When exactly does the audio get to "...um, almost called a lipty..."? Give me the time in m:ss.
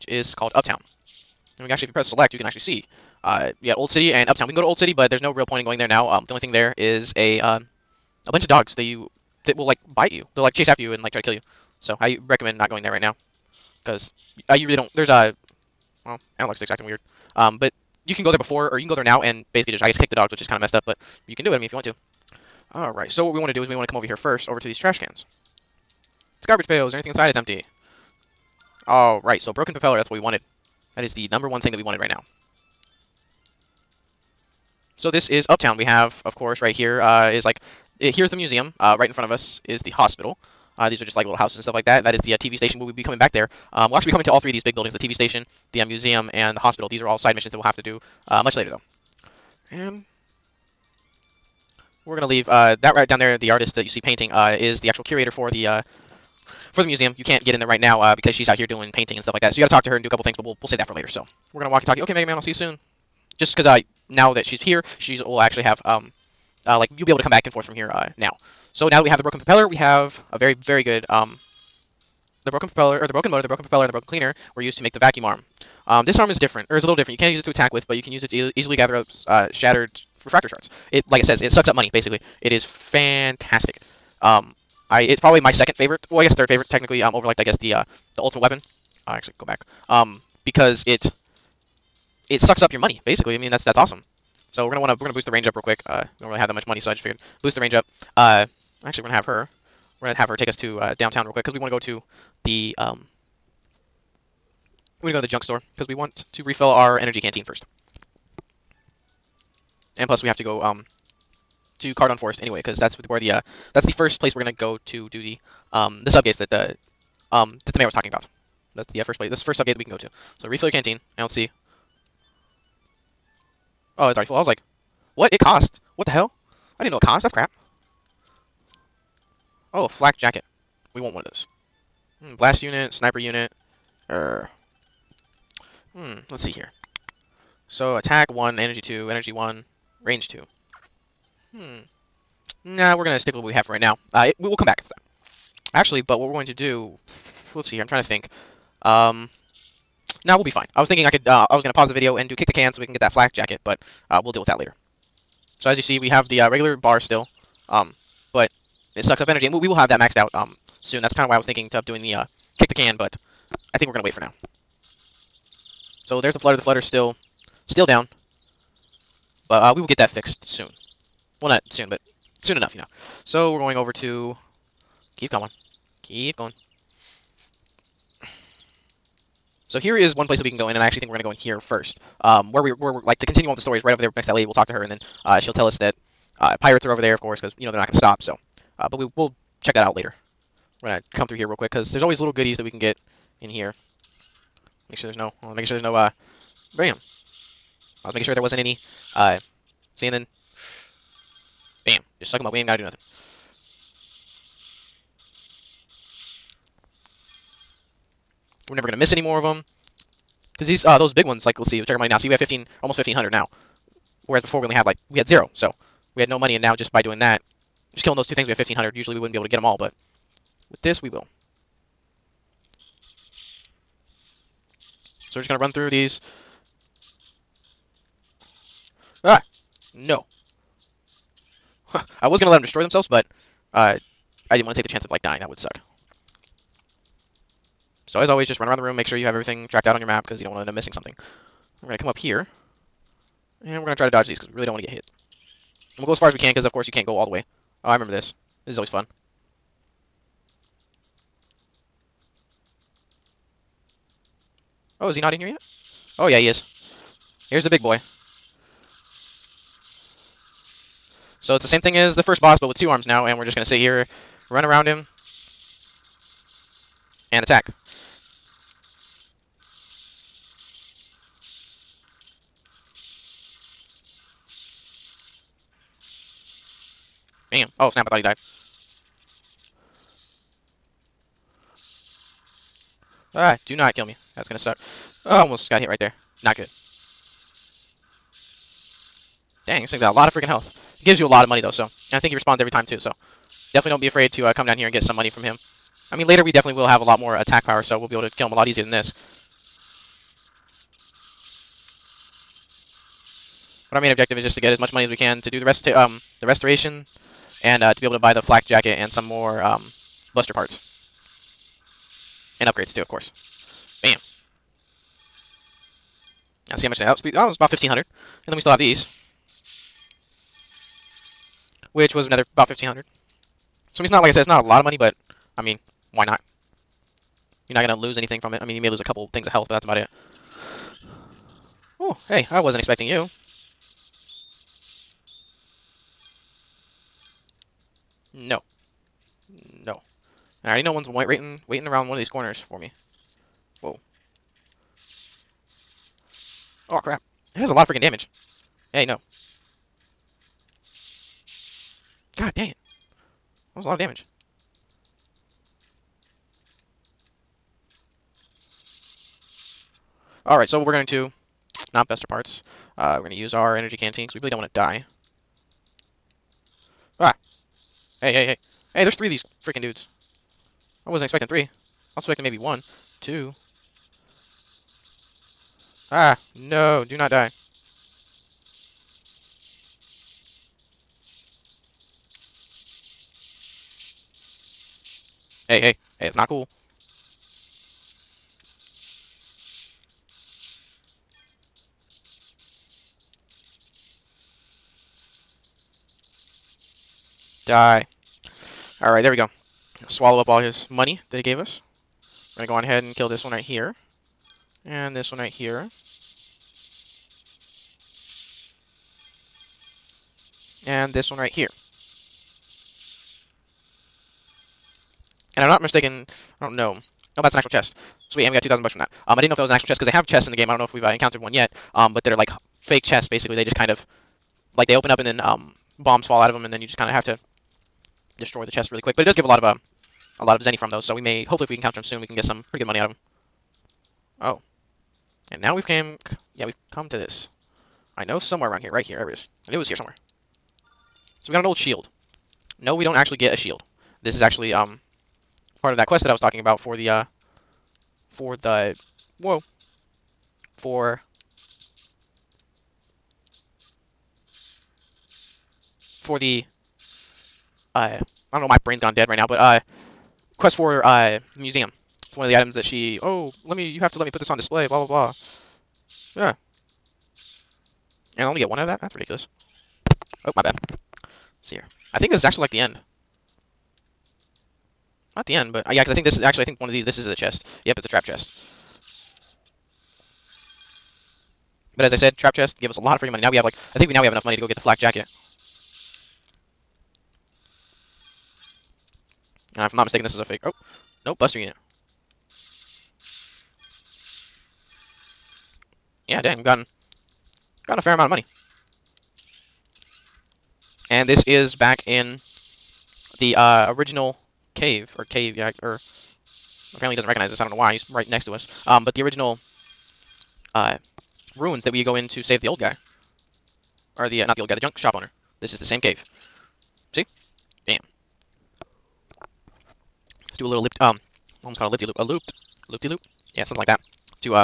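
8:40.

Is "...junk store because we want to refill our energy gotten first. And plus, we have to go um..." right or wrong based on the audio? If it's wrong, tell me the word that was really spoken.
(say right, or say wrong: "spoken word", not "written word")
wrong: "canteen", not "gotten".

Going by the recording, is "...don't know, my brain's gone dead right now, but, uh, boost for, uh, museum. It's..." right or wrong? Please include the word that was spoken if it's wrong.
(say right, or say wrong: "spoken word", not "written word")
wrong: "quest", not "boost".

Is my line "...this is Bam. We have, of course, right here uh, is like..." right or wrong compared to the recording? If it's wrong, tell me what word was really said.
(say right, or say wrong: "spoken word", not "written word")
wrong: "Uptown", not "Bam".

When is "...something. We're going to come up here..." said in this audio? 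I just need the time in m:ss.
4:00.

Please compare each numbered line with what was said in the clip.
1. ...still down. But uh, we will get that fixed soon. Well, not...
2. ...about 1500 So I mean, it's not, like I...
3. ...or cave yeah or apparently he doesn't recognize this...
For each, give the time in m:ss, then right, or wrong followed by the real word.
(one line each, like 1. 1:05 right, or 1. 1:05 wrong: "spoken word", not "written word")
1. 2:47 right
2. 5:22 right
3. 8:25 right.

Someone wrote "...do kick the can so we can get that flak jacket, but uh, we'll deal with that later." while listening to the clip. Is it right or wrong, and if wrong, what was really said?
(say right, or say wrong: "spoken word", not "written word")
right.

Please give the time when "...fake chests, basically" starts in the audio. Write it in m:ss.
7:02.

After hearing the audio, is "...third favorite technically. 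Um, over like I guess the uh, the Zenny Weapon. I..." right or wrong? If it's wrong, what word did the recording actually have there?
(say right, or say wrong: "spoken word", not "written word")
wrong: "Ultimate", not "Zenny".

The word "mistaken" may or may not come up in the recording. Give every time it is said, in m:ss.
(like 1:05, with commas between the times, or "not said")
6:55, 8:10.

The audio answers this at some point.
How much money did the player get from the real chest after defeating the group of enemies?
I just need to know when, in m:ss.
6:58.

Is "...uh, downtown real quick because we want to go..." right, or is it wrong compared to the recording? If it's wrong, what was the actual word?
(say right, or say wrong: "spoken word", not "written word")
right.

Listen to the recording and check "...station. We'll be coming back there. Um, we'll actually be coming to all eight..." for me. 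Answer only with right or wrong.
wrong.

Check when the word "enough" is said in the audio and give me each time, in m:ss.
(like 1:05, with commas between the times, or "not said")
2:52, 8:04.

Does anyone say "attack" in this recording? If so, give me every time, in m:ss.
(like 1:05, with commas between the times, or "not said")
1:17, 2:17, 4:27, 4:57.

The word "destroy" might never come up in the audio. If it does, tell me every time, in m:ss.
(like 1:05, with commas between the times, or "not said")
3:52, 7:08.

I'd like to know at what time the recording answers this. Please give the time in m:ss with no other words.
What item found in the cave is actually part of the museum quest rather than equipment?
7:21.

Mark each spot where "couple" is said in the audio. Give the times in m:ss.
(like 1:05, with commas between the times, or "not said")
1:00, 5:29.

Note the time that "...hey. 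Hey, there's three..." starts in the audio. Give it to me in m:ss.
6:08.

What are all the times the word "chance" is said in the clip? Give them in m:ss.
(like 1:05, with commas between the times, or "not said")
3:54.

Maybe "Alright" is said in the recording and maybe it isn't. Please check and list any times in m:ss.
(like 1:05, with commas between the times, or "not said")
4:43, 6:00, 6:39.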